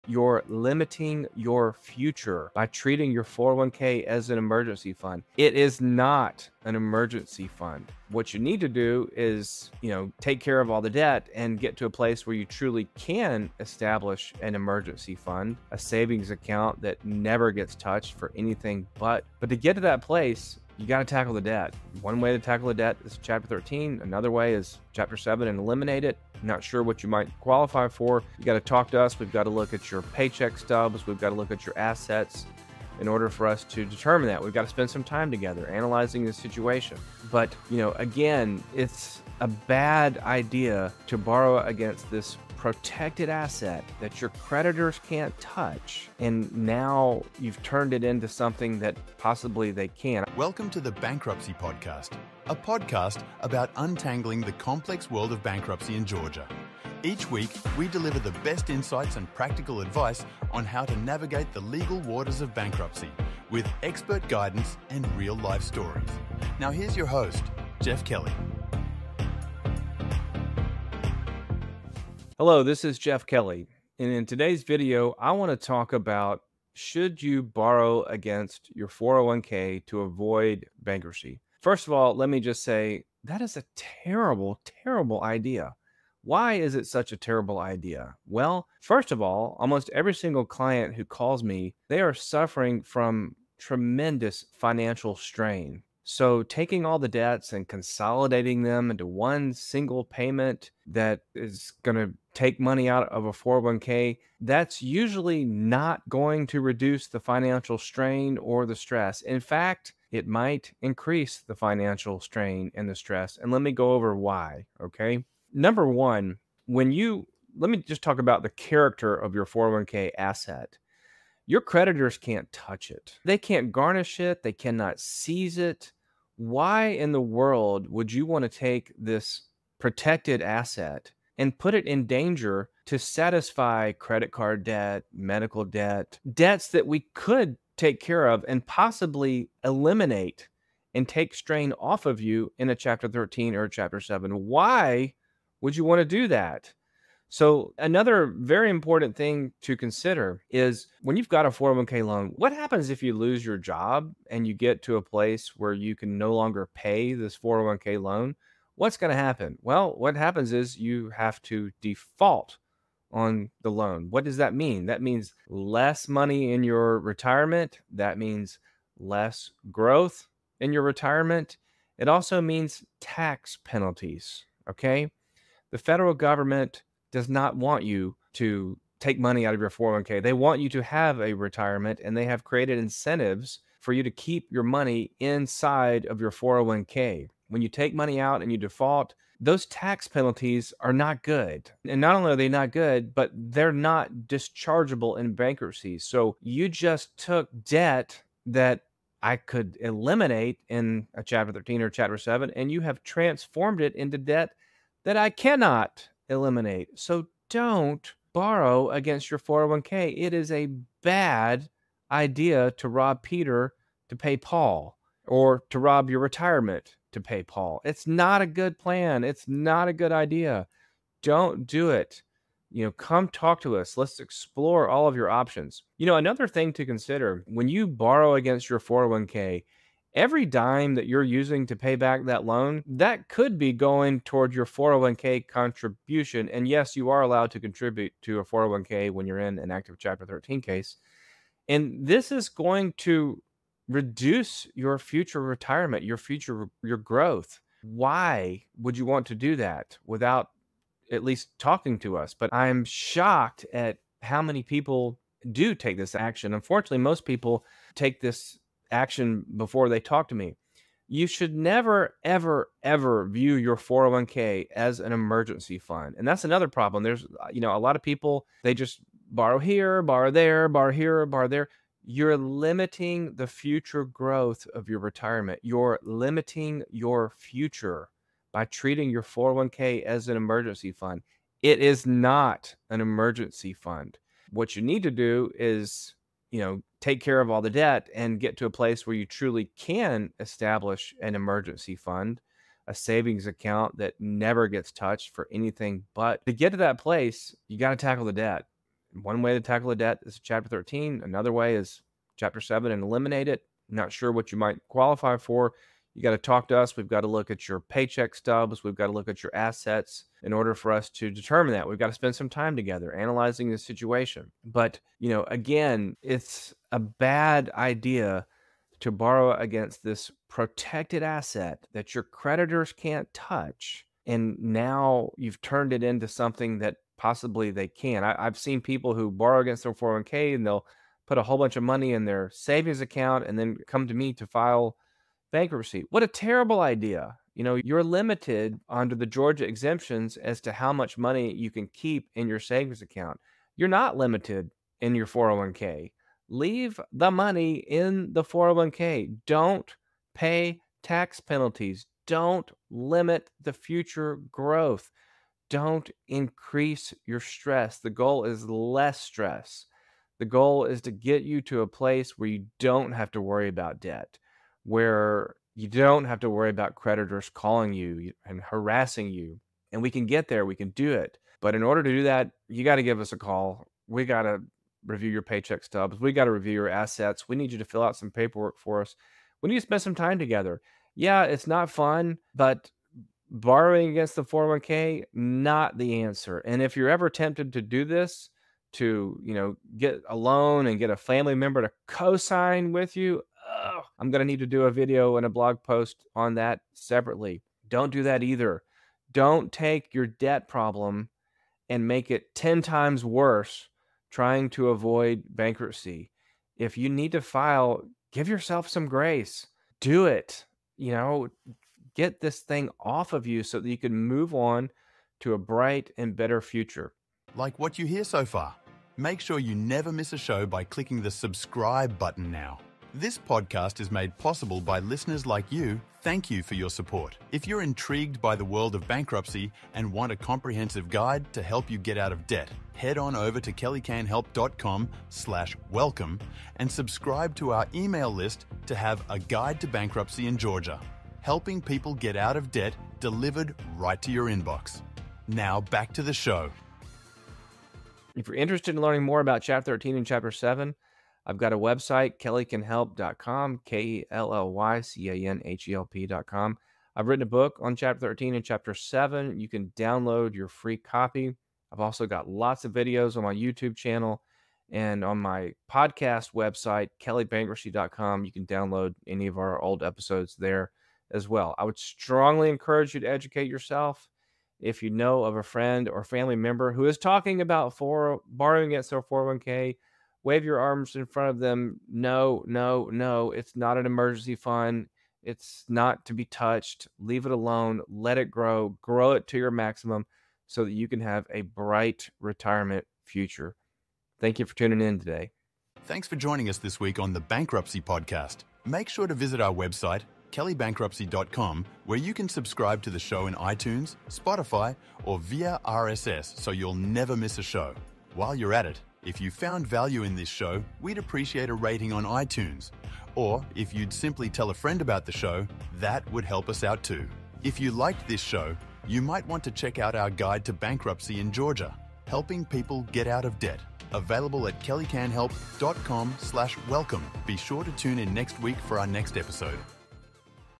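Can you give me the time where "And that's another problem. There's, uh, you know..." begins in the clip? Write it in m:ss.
4:26.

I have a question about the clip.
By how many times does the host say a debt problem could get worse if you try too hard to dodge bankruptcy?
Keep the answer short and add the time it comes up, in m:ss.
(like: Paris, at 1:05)
10, at 6:42.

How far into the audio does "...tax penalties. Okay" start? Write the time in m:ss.
2:52.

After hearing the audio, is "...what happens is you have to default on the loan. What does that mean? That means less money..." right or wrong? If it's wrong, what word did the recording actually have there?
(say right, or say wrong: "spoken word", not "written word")
right.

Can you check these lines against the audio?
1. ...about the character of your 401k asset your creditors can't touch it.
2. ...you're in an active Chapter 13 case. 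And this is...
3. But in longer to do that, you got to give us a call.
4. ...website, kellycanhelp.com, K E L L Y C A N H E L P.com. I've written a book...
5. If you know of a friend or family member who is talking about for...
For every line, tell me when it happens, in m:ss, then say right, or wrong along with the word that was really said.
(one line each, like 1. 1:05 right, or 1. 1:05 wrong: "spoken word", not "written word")
1. 1:58 right
2. 3:59 right
3. 6:11 wrong: "order", not "longer"
4. 7:31 right
5. 7:54 right.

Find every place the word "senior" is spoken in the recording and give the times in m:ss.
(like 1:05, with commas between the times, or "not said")
not said.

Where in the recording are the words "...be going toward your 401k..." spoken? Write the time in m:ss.
3:53.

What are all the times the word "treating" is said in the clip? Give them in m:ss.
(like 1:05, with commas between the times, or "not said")
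0:02, 4:38.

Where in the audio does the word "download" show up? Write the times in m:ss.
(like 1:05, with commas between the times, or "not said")
7:39, 7:48.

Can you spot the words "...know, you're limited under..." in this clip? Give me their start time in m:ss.
5:37.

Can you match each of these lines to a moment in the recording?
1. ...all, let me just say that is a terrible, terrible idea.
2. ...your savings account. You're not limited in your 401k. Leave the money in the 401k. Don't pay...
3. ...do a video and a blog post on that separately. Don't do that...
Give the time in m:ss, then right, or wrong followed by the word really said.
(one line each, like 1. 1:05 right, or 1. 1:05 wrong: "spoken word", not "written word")
1. 1:21 right
2. 5:42 right
3. 6:34 right.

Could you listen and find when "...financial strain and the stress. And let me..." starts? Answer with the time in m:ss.
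1:51.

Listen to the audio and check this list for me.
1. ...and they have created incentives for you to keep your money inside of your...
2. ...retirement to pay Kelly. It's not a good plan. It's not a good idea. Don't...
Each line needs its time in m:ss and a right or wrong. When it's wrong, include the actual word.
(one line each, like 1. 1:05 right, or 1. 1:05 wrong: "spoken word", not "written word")
1. 3:02 right
2. 3:36 wrong: "Paul", not "Kelly".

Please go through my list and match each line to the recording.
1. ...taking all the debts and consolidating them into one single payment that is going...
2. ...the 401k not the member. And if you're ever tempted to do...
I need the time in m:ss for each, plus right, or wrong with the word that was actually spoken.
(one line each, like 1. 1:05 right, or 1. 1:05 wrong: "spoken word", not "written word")
1. 1:36 right
2. 6:24 wrong: "answer", not "member".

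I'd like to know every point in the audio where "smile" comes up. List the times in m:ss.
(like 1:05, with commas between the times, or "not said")
not said.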